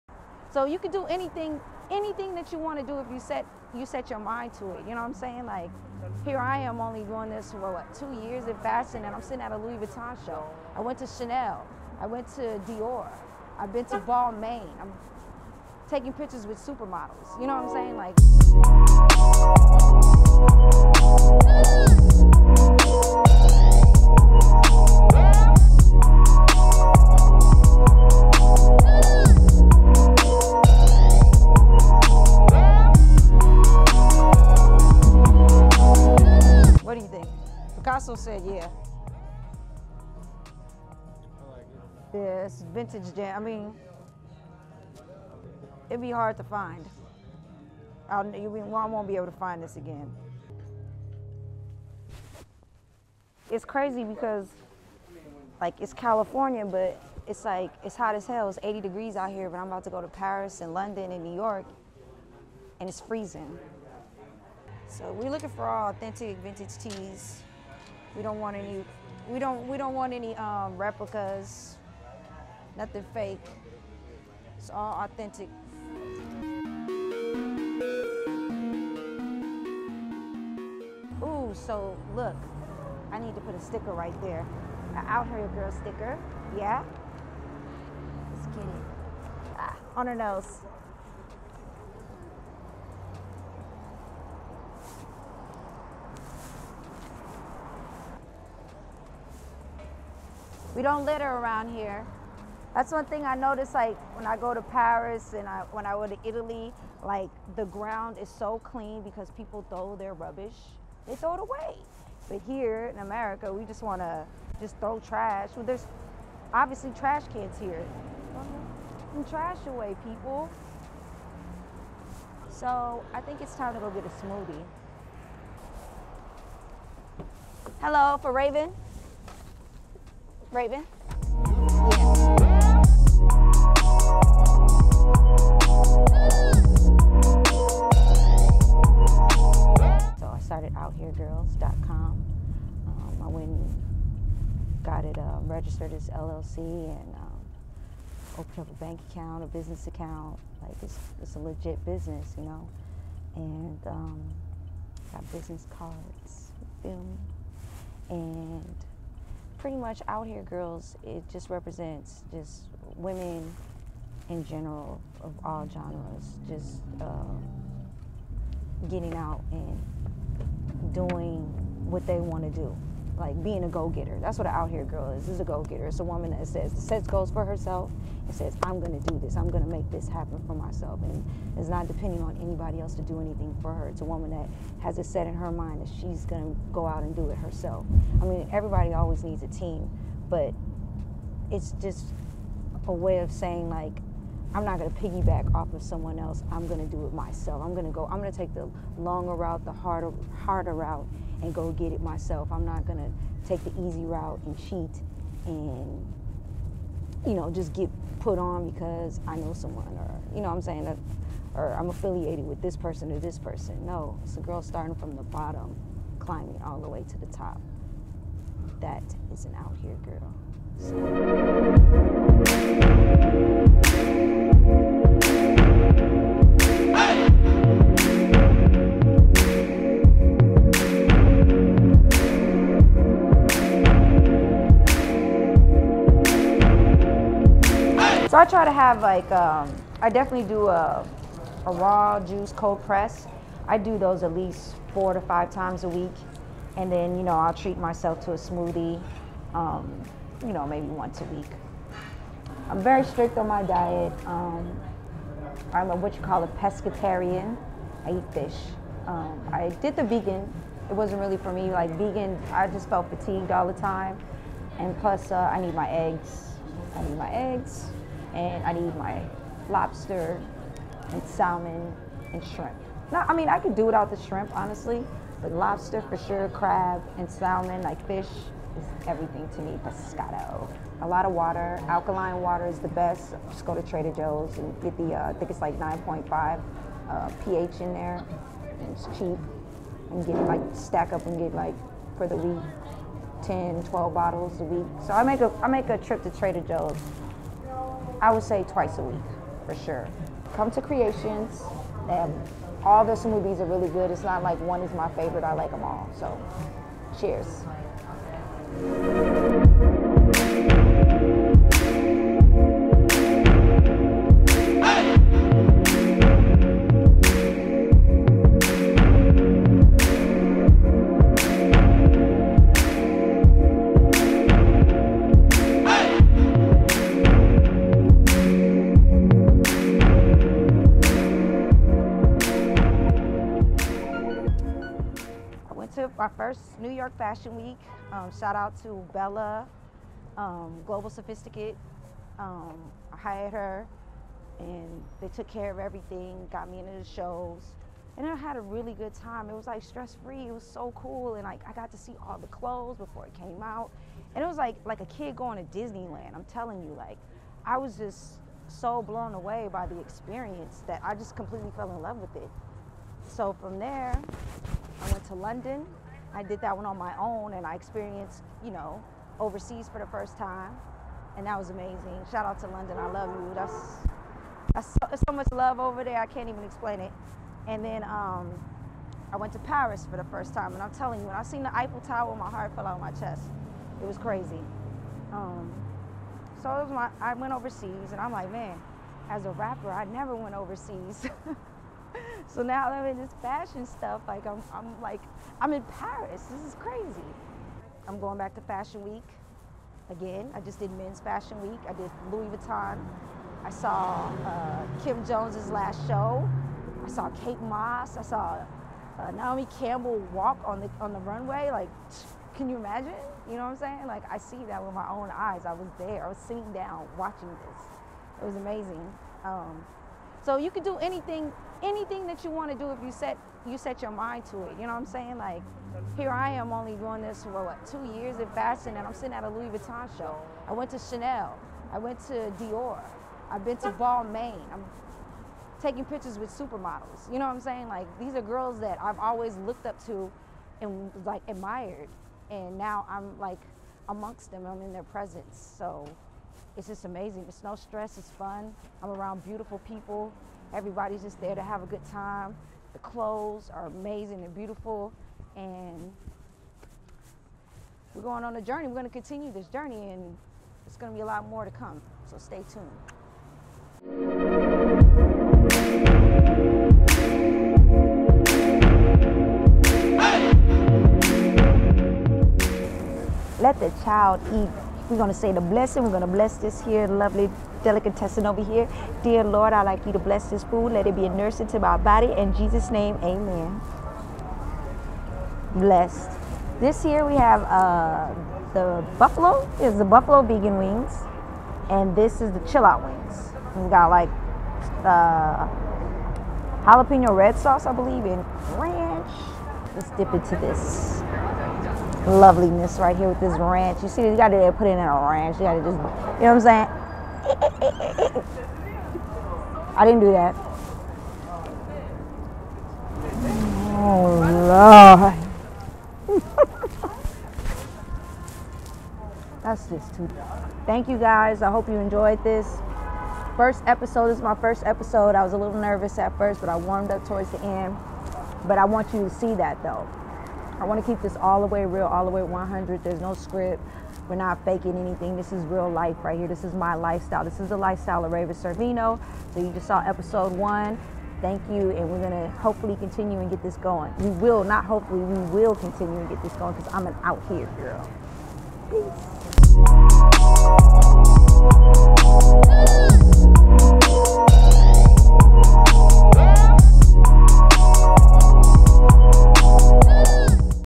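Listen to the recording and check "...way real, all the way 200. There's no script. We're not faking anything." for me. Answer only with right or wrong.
wrong.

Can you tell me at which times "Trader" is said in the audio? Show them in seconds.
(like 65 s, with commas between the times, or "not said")
283 s, 296 s.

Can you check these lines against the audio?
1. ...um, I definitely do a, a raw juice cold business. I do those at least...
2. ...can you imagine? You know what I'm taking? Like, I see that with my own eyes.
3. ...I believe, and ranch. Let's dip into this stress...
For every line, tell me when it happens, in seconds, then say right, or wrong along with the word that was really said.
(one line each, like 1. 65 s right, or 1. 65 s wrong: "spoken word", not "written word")
1. 239 s wrong: "press", not "business"
2. 412 s wrong: "saying", not "taking"
3. 497 s wrong: "loveliness", not "stress".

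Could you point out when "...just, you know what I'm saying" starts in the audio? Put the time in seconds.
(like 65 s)
505 s.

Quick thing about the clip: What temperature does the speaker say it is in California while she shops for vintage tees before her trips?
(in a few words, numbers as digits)
80 degrees.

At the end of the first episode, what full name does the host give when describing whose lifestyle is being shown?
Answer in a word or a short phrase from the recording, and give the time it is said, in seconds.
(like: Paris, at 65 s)
Raven Sorvino, at 538 s.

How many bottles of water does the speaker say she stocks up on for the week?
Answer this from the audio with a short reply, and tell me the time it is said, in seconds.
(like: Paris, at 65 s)
10, 12, at 293 s.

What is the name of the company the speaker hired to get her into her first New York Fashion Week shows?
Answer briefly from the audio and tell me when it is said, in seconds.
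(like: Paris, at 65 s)
Global Sophisticate, at 340 s.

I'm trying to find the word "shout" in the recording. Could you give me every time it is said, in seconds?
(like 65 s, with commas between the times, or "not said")
338 s, 372 s.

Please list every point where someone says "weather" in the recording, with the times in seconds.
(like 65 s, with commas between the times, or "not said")
not said.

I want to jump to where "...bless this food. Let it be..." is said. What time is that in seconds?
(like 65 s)
480 s.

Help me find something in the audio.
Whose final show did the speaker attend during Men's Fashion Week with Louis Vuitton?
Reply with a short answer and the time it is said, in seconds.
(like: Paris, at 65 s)
Kim Jones, at 405 s.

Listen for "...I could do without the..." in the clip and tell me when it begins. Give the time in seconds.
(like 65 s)
273 s.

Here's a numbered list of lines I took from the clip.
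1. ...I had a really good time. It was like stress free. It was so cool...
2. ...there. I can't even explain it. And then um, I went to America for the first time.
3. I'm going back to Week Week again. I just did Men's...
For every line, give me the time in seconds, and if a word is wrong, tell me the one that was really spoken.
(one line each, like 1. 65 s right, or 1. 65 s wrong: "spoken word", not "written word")
1. 348 s right
2. 376 s wrong: "Paris", not "America"
3. 398 s wrong: "Fashion", not "Week".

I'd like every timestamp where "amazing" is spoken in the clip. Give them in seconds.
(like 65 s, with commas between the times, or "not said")
371 s, 418 s, 447 s, 453 s.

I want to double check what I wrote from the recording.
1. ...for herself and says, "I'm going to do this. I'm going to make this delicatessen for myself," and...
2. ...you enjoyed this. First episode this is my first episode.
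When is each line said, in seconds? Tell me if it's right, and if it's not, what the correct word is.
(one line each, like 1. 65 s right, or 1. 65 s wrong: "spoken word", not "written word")
1. 177 s wrong: "happen", not "delicatessen"
2. 521 s right.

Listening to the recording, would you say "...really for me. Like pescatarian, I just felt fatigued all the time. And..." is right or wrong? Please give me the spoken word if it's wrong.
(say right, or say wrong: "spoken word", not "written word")
wrong: "vegan", not "pescatarian".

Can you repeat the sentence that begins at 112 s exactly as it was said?
But here in America, we just want to just throw trash.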